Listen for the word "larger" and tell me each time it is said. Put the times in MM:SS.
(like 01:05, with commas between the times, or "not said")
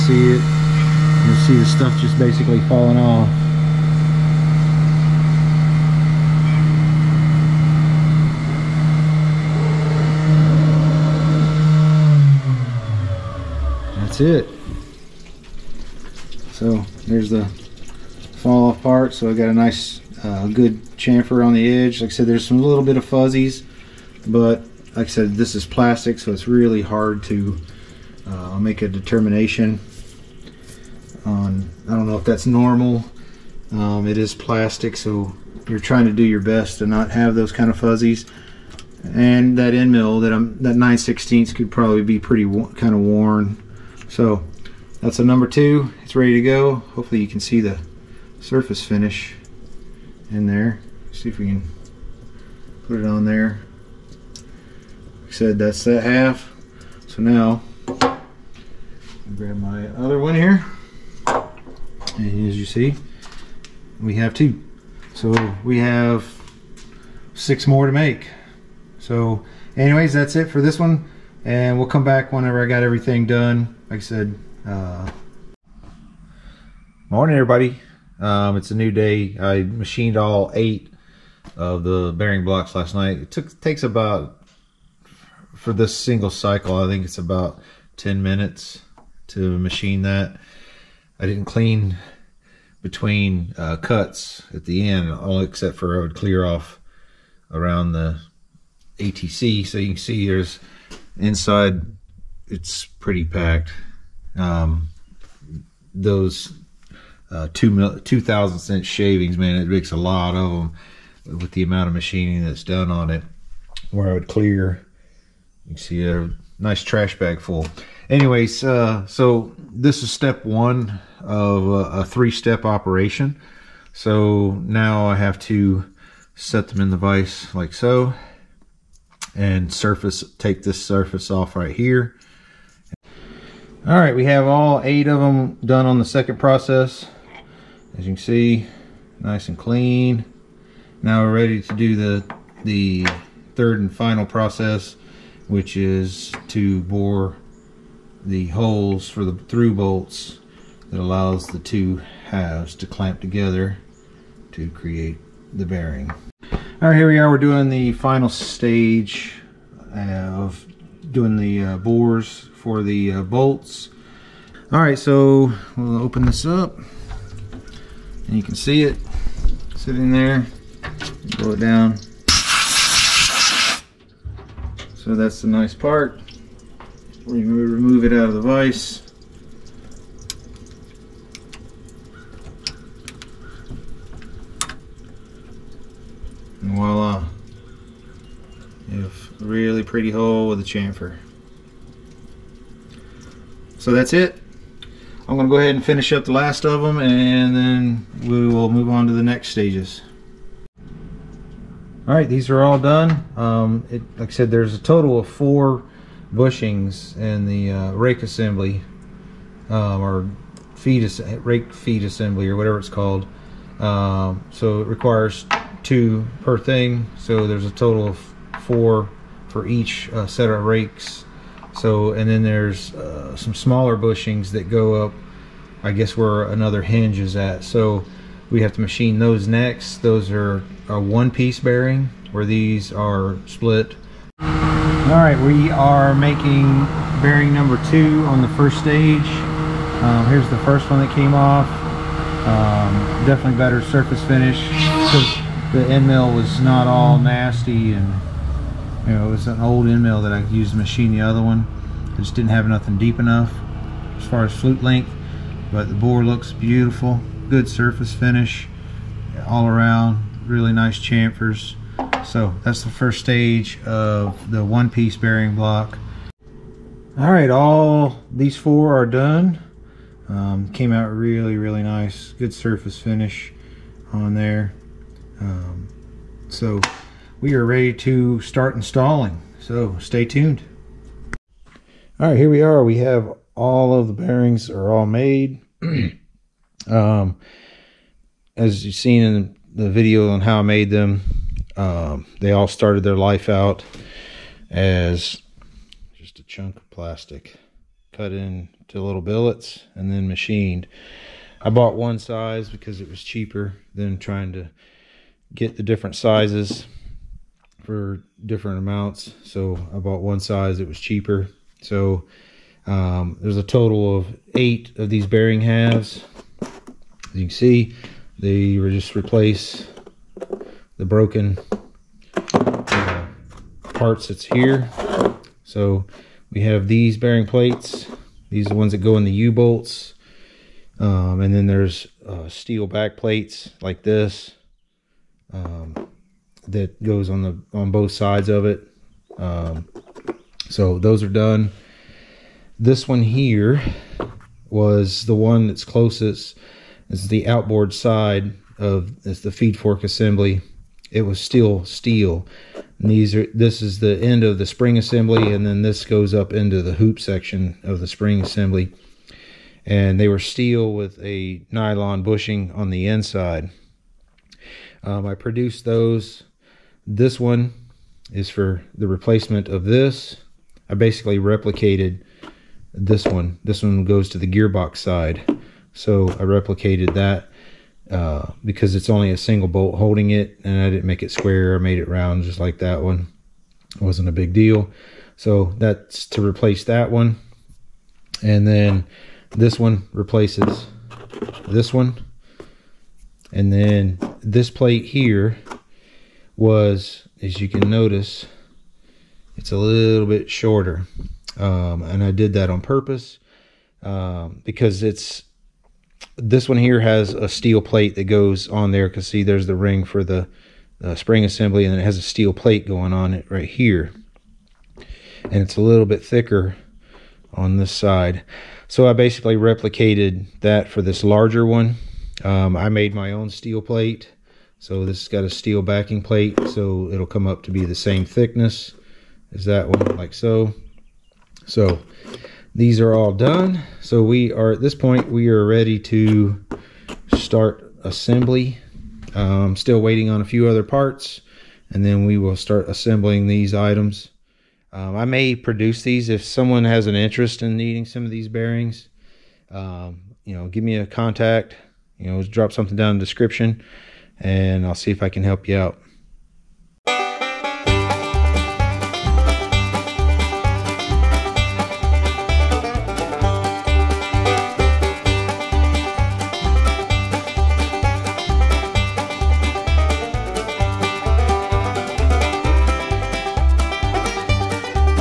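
07:01.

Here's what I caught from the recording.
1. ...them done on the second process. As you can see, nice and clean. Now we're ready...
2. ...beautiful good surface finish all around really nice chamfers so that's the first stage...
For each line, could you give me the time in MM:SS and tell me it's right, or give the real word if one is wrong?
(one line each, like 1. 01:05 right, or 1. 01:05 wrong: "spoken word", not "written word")
1. 02:15 right
2. 04:16 right.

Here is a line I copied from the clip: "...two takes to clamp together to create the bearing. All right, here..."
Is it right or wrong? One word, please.
wrong.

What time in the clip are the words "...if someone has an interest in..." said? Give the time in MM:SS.
07:26.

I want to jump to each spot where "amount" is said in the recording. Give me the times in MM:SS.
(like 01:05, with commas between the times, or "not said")
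01:51, 05:08.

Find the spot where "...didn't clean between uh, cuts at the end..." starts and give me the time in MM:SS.
01:31.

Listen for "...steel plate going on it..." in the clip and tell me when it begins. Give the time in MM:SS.
06:52.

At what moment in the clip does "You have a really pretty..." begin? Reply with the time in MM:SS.
03:08.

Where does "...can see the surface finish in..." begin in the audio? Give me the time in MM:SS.
00:47.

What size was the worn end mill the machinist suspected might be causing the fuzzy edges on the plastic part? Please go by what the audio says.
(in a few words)
9/16.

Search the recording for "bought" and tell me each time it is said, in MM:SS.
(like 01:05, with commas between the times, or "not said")
05:01, 05:09.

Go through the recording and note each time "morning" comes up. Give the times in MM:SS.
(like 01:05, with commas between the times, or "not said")
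01:17.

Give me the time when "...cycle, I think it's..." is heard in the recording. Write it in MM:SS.
01:26.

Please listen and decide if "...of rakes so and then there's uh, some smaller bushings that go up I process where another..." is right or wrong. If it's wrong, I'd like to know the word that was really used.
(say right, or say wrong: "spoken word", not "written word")
wrong: "guess", not "process".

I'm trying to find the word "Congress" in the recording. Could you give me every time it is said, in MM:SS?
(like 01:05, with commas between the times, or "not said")
not said.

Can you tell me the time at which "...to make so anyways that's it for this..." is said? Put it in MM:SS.
01:07.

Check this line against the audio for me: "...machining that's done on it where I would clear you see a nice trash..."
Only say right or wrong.
right.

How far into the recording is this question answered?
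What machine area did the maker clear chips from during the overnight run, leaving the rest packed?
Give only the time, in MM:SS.
01:38.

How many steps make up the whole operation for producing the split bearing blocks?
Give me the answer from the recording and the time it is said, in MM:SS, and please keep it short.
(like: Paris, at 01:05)
3, at 02:02.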